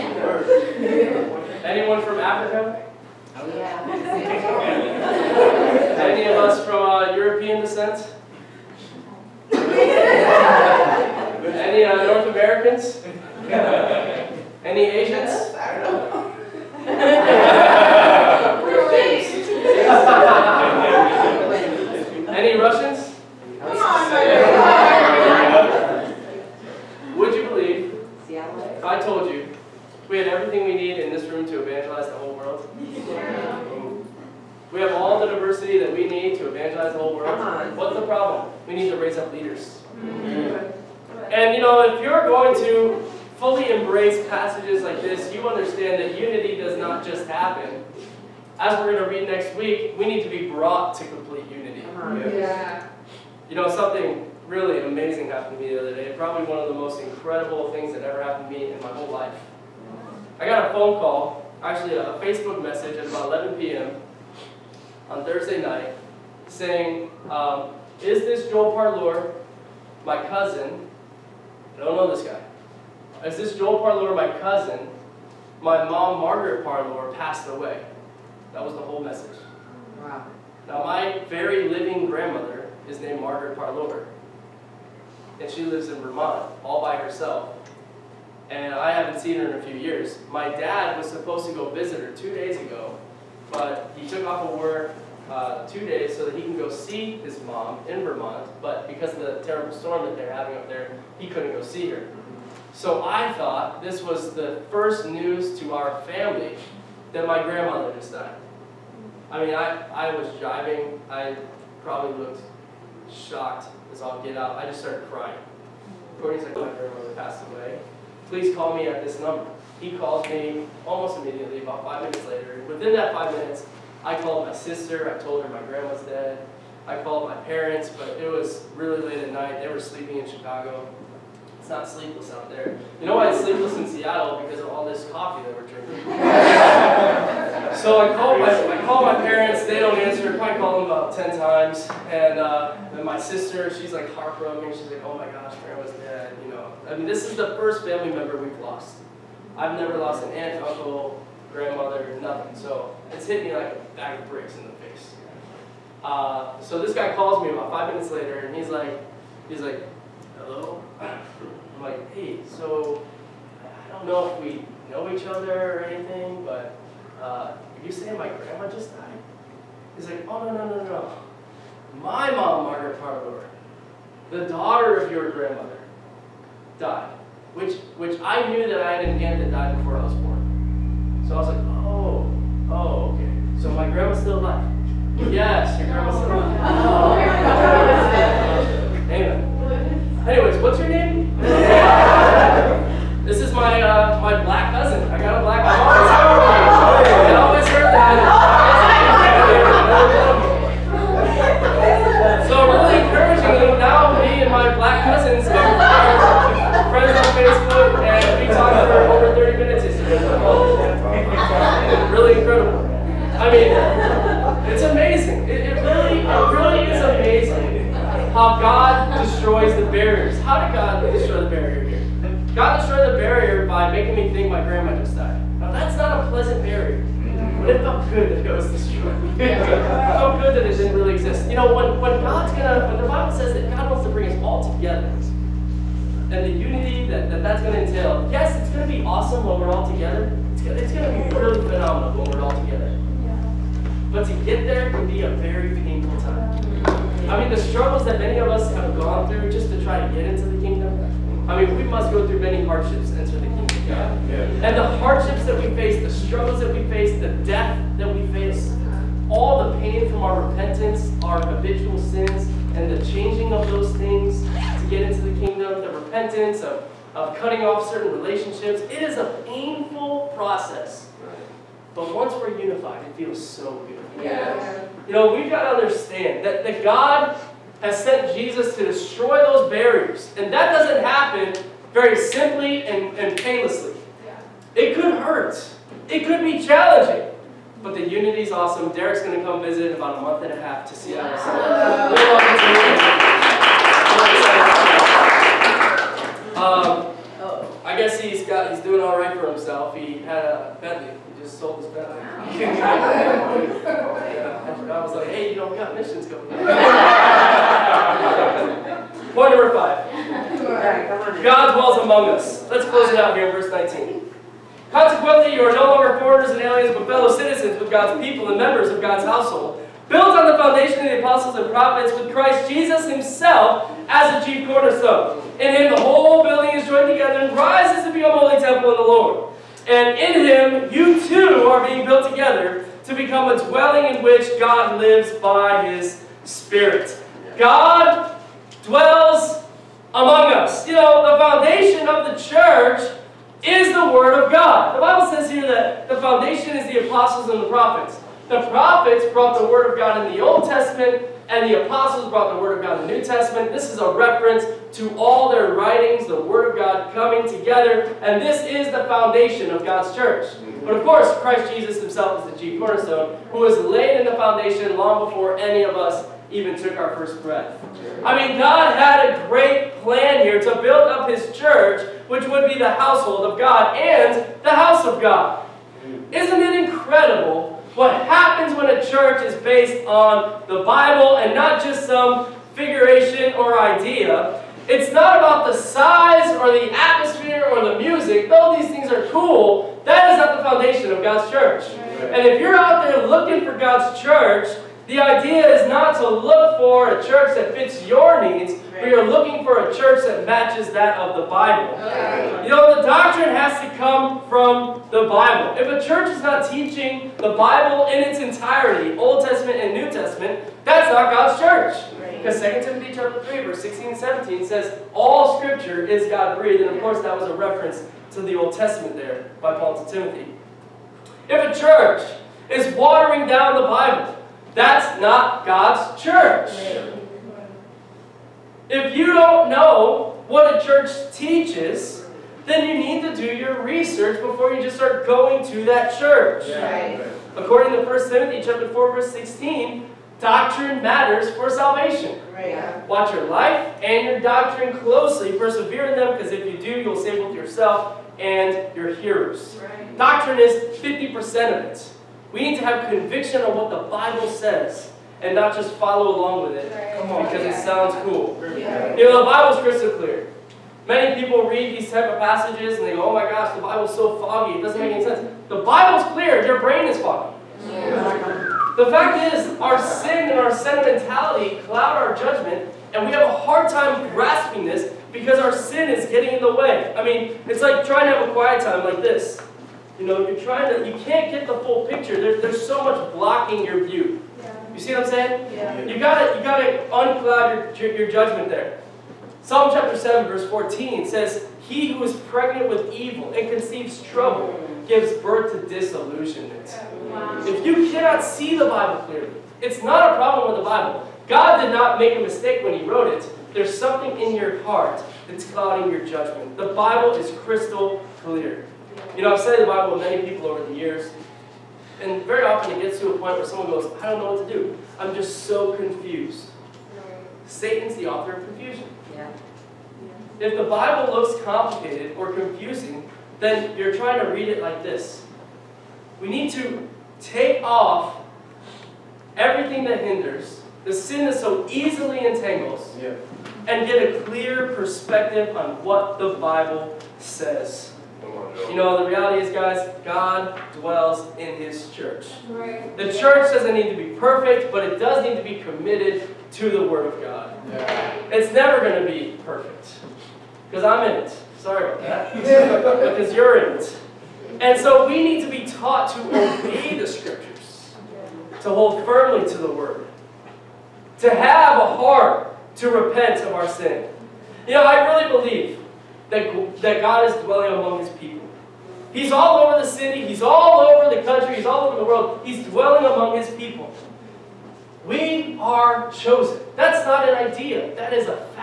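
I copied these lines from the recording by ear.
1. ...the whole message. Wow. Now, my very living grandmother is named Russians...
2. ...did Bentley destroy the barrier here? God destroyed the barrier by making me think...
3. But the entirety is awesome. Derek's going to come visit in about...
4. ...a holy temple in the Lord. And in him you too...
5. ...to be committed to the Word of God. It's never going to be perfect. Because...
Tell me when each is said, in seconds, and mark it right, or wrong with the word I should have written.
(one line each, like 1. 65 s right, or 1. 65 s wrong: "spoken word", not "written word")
1. 78 s wrong: "Margaret", not "Russians"
2. 220 s wrong: "God", not "Bentley"
3. 287 s wrong: "unity", not "entirety"
4. 328 s right
5. 545 s right.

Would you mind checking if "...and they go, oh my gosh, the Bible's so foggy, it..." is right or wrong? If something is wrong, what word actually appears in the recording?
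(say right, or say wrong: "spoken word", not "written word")
right.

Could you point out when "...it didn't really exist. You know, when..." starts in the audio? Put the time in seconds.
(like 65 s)
230 s.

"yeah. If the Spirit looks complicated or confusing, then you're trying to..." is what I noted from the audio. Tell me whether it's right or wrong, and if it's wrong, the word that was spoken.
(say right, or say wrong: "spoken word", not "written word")
wrong: "Bible", not "Spirit".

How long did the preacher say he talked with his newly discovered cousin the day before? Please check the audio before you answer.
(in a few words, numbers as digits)
Over 30 minutes.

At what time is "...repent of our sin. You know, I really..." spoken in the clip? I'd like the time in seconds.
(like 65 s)
563 s.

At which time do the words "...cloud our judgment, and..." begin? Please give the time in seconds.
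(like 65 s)
471 s.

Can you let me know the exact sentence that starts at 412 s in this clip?
Because 2 Timothy chapter 3, verse 16 and 17 says, All scripture is God-breathed.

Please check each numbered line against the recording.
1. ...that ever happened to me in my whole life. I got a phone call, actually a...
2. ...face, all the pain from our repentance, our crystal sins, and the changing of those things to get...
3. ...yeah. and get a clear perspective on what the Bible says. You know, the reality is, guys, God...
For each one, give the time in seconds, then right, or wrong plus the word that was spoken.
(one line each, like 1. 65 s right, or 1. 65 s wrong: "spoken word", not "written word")
1. 57 s right
2. 258 s wrong: "habitual", not "crystal"
3. 533 s right.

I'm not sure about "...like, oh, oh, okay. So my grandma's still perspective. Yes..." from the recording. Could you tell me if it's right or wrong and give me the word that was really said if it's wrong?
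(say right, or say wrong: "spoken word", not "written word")
wrong: "alive", not "perspective".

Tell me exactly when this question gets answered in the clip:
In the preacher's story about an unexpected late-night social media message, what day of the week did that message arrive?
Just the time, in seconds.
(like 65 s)
65 s.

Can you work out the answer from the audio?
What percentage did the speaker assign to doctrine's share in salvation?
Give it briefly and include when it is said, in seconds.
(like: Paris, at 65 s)
50%, at 450 s.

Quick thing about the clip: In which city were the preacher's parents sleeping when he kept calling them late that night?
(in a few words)
Chicago.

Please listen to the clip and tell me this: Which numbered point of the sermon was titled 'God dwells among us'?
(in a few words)
5.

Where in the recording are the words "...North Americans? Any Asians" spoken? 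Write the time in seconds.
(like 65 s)
12 s.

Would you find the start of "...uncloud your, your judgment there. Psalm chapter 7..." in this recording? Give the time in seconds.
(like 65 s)
487 s.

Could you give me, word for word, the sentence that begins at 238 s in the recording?
Yes, it's going to be awesome when we're all together.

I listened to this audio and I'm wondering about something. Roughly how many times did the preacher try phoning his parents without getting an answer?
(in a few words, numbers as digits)
10.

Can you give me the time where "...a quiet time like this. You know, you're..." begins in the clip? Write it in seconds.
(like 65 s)
478 s.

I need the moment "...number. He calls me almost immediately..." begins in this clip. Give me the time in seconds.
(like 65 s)
119 s.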